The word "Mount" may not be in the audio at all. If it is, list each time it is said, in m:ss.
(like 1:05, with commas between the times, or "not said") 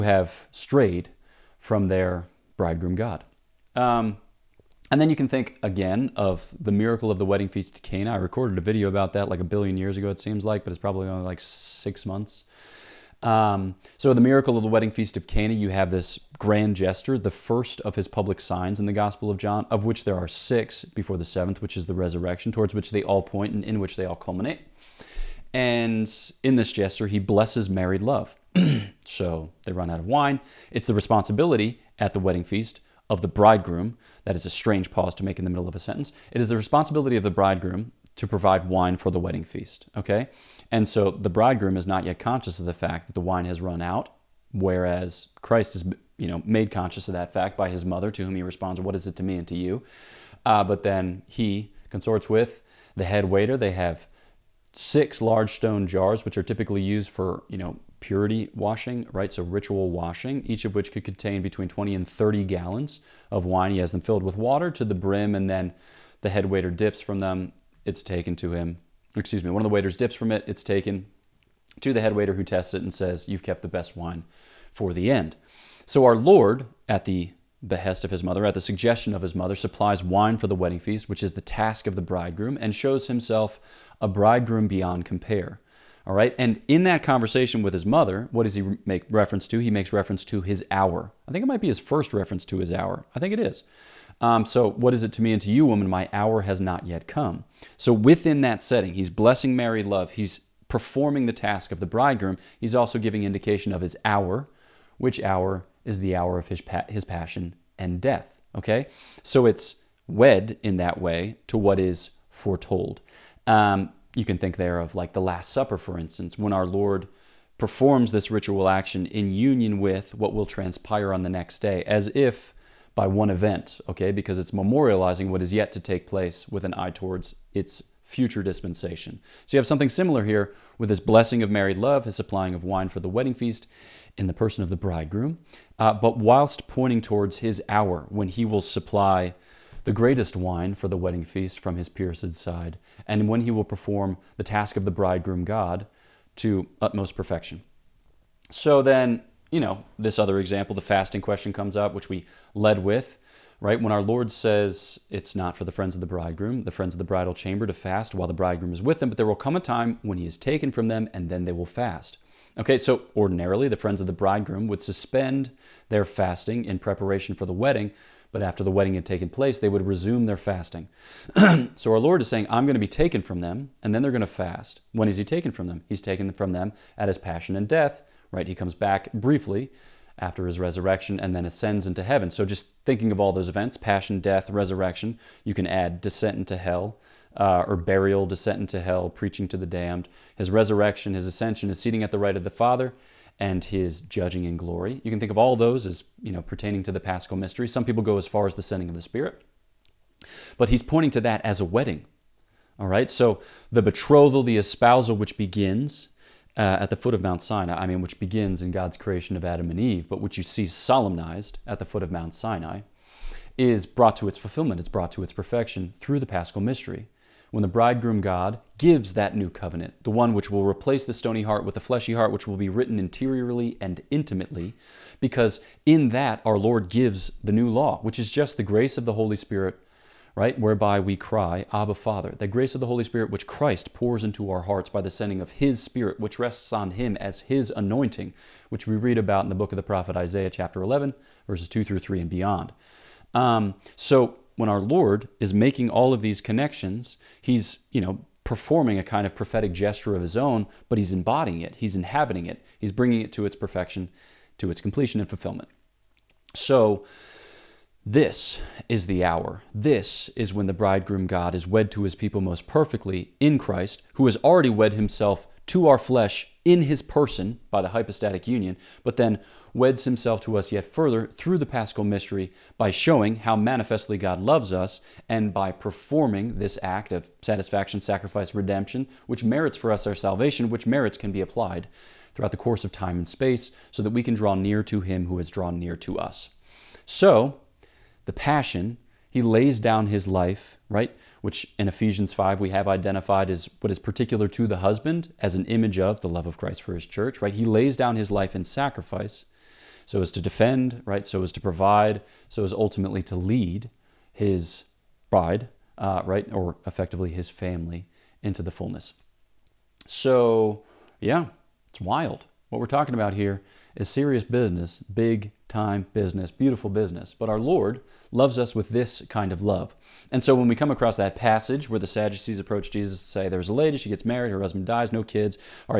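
3:27, 3:32.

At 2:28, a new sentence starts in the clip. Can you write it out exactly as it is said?
So then, you know, this other example, the fasting question comes up, which we led with, right?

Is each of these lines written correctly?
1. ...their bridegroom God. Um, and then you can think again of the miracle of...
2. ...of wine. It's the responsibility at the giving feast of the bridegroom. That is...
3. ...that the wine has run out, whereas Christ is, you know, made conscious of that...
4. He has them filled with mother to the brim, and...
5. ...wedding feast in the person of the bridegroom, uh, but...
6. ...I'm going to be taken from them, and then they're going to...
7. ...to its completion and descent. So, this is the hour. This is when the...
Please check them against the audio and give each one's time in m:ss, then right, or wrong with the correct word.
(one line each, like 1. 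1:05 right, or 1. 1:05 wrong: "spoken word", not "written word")
1. 0:01 right
2. 0:29 wrong: "wedding", not "giving"
3. 0:43 right
4. 1:03 wrong: "water", not "mother"
5. 2:13 right
6. 2:52 right
7. 4:14 wrong: "fulfillment", not "descent".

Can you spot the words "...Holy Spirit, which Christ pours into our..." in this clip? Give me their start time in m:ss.
3:52.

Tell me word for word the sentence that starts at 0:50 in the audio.
Uh, but then he consorts with the head waiter.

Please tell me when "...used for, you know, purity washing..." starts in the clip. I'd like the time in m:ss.
0:56.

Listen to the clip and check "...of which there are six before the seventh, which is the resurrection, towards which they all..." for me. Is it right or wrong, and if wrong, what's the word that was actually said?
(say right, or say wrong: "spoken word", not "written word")
right.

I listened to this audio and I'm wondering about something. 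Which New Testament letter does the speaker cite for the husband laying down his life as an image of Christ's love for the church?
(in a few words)
Ephesians 5.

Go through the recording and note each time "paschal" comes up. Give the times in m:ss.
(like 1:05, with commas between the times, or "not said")
3:16, 3:36, 4:31.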